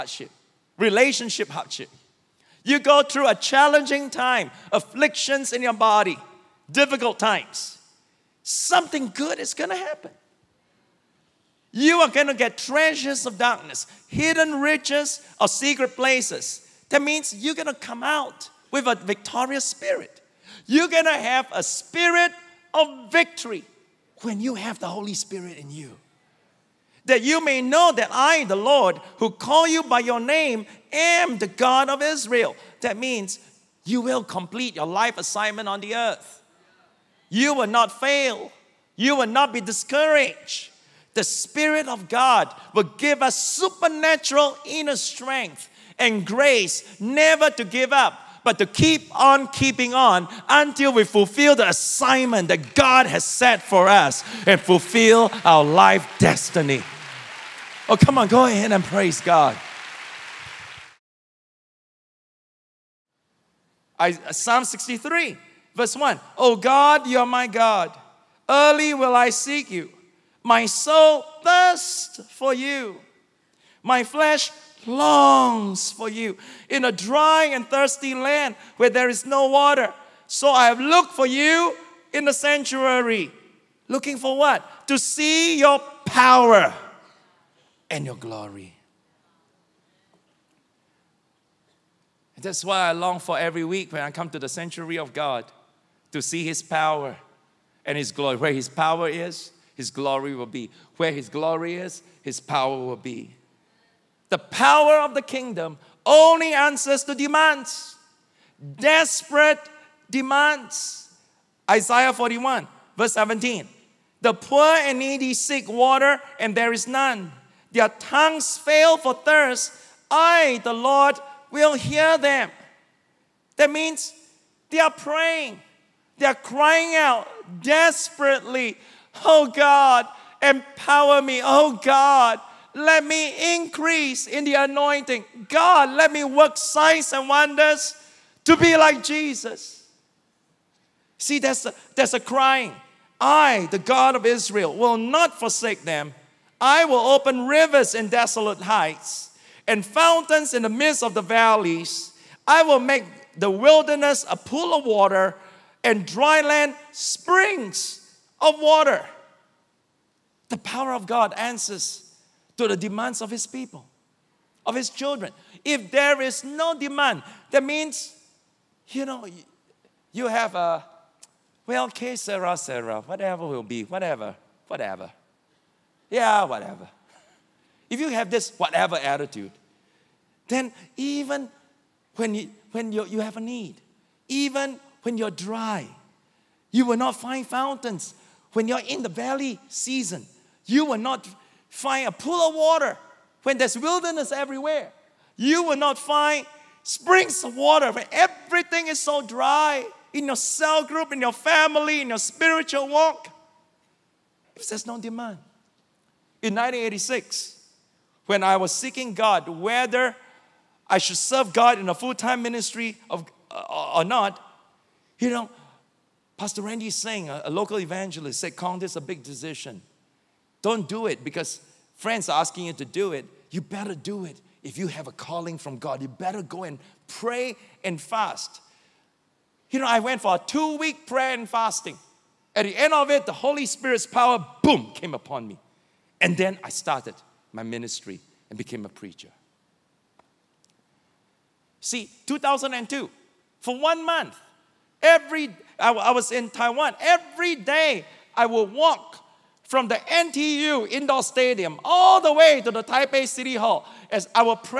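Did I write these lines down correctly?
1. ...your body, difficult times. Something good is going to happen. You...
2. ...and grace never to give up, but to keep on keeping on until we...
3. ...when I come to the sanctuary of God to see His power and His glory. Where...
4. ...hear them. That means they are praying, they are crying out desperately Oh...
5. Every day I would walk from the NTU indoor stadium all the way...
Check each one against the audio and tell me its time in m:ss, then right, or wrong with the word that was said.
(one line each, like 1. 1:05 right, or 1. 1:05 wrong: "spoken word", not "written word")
1. 0:05 right
2. 0:45 right
3. 1:33 right
4. 2:01 right
5. 4:06 right.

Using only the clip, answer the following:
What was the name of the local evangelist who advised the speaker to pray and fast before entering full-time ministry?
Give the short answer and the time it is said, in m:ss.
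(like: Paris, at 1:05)
Randy Singh, at 3:36.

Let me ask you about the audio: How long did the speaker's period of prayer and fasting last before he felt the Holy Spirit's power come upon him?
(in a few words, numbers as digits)
2 weeks.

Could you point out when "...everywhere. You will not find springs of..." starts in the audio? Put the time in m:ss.
3:14.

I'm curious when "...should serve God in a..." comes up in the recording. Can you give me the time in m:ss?
3:30.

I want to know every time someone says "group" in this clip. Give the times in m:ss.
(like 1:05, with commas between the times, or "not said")
3:20.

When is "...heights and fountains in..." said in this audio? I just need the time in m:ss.
2:28.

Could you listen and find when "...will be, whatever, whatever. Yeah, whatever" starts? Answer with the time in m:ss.
2:53.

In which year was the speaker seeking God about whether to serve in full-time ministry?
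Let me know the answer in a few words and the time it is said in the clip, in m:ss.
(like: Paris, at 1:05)
1986, at 3:26.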